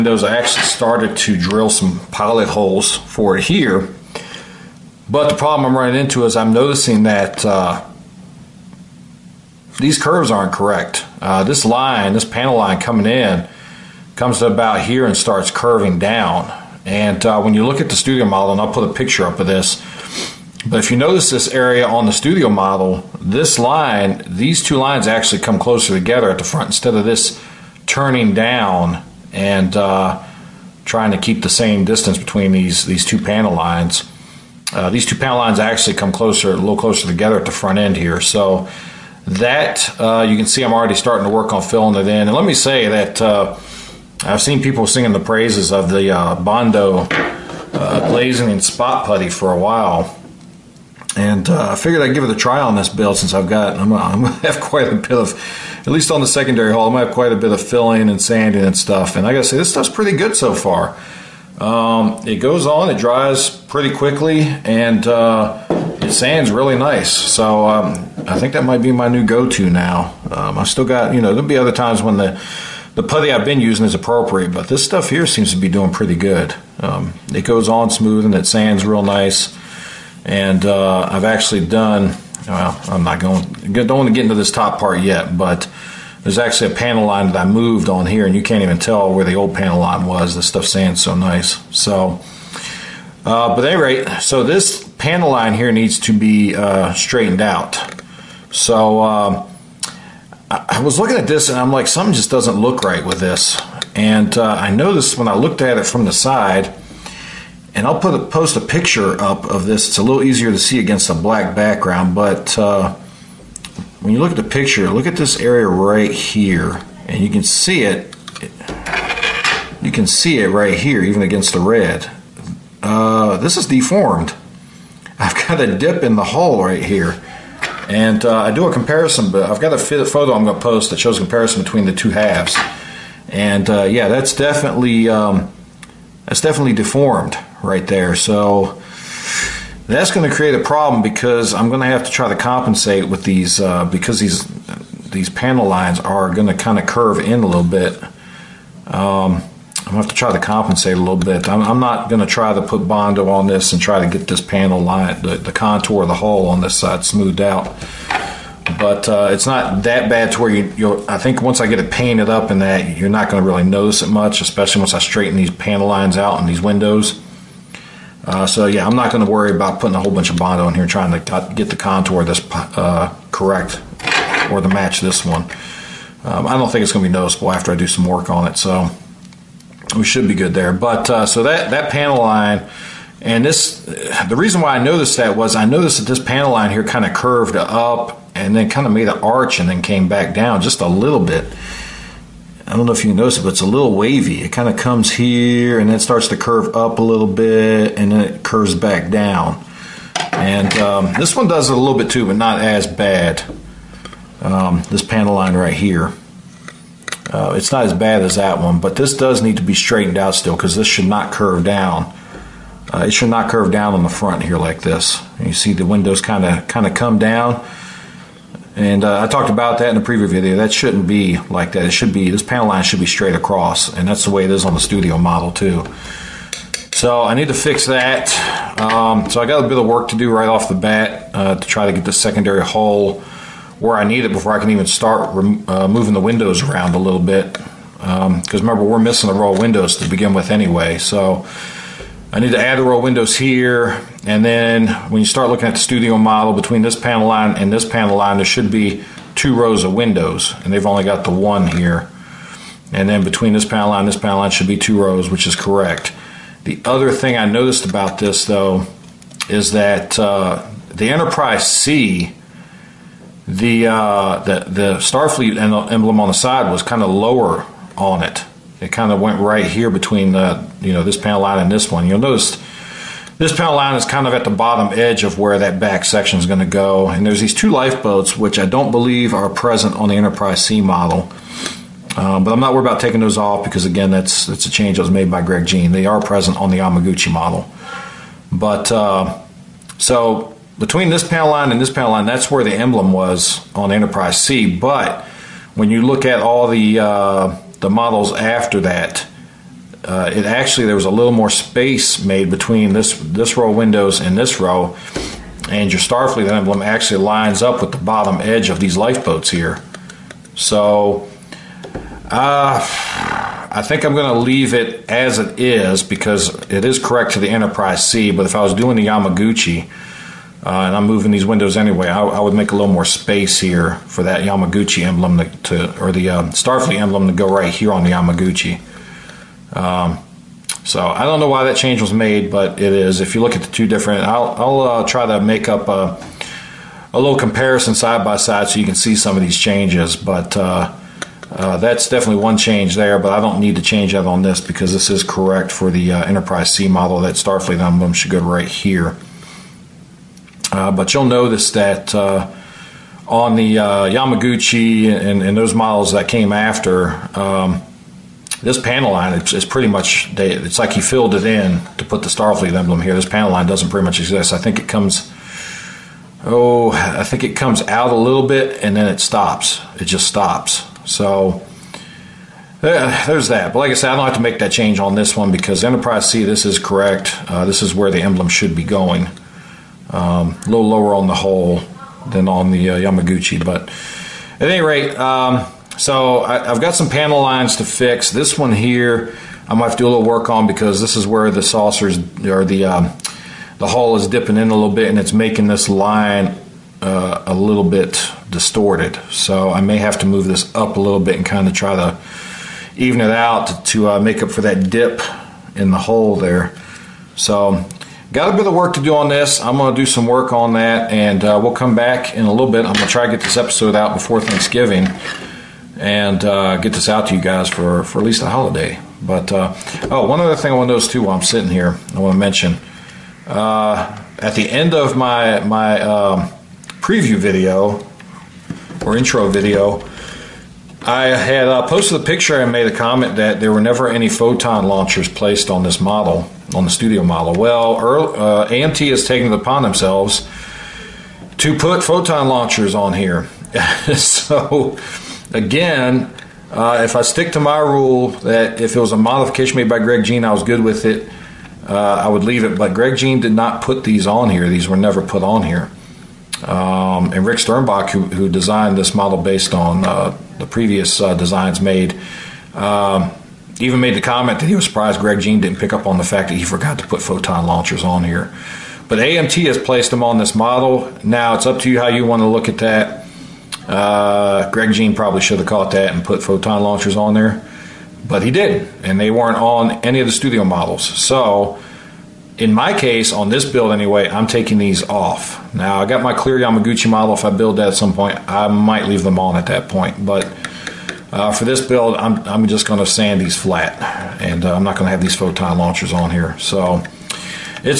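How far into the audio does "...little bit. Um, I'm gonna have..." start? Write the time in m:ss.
2:27.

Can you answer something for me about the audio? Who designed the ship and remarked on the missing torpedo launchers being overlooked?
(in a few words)
Rick Sternbach.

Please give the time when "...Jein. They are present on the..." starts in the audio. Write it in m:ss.
4:45.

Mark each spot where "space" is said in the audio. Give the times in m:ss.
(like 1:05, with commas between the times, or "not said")
5:01, 5:23.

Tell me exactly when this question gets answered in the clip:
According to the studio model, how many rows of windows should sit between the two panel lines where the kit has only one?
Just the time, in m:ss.
4:09.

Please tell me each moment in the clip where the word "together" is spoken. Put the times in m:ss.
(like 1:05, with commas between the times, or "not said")
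0:25, 0:37.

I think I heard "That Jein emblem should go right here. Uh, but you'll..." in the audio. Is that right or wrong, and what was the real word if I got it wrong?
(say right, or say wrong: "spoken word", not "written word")
wrong: "Starfleet", not "Jein".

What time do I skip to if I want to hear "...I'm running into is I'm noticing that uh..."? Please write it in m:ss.
0:05.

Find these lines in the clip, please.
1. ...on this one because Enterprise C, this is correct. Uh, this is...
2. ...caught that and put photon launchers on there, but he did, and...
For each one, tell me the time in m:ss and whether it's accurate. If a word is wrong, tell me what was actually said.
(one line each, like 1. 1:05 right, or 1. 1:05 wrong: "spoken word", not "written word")
1. 6:14 right
2. 7:55 right.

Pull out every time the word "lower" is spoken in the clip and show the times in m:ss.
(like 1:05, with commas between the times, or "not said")
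4:27, 6:20.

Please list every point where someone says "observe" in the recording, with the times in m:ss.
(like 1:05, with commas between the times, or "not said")
not said.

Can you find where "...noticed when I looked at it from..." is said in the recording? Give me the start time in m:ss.
1:44.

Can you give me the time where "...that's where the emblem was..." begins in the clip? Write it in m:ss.
4:52.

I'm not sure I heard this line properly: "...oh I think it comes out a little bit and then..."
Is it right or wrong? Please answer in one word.
right.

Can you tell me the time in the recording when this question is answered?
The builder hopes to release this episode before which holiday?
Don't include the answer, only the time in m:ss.
6:54.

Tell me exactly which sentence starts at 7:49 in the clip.
But AMT has placed them on this model.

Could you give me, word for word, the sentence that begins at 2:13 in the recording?
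And uh, yeah, that's definitely um, that's definitely deformed right there.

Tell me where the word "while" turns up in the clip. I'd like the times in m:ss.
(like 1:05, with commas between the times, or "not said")
0:49, 7:01.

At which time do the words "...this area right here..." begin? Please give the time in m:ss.
1:55.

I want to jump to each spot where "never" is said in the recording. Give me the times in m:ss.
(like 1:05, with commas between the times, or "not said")
7:13, 7:34.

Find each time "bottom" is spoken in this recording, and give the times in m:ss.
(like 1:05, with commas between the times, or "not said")
4:34, 5:07.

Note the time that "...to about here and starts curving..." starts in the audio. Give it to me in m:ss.
0:14.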